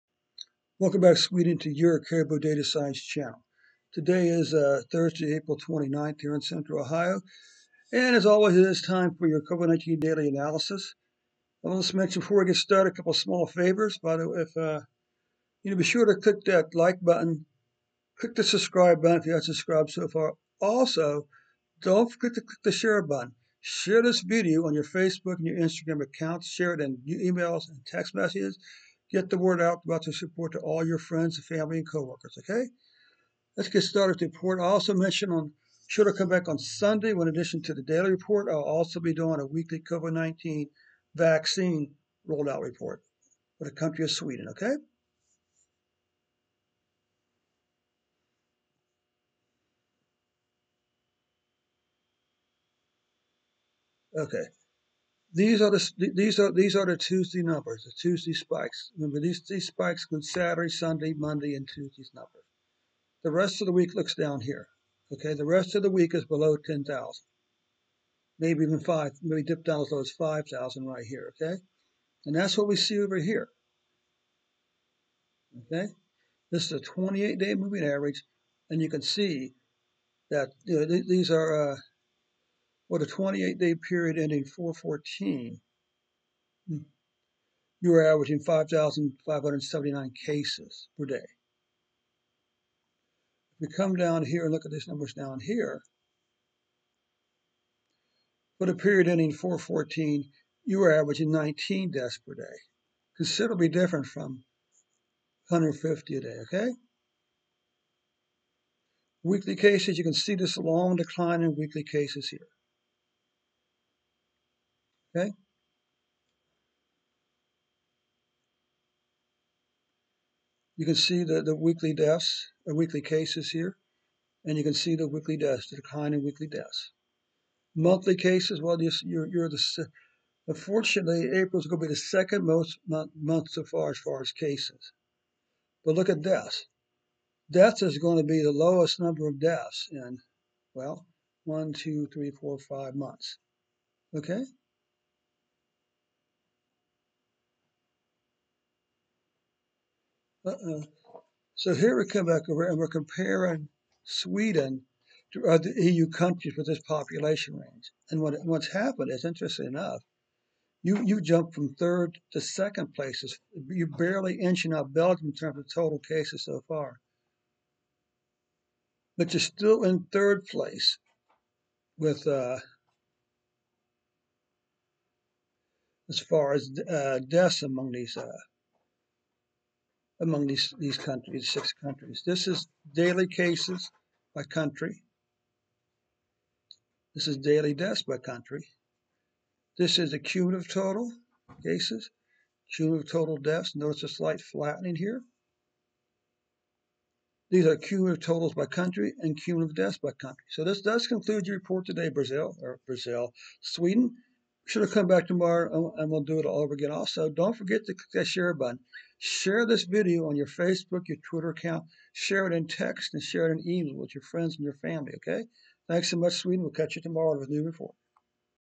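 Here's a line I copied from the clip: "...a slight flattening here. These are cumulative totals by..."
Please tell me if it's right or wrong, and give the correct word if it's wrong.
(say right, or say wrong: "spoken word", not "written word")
right.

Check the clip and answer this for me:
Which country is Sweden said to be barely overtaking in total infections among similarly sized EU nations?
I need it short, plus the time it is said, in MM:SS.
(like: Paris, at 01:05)
Belgium, at 02:44.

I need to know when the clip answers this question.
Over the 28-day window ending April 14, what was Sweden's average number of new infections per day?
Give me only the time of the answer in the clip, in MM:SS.
01:28.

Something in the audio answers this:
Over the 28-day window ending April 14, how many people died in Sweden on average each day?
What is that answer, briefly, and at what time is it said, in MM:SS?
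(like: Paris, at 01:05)
19, at 01:41.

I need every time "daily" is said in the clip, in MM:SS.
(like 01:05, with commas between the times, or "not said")
00:09, 00:37, 03:02, 03:07.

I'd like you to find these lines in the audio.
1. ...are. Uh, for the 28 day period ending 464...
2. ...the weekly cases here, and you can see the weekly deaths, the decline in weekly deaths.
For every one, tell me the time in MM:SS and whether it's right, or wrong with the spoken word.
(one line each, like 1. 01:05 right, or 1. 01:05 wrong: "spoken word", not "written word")
1. 01:21 wrong: "414", not "464"
2. 02:02 right.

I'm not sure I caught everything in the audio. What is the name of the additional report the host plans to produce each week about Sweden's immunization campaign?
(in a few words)
COVID-19 vaccine rollout report.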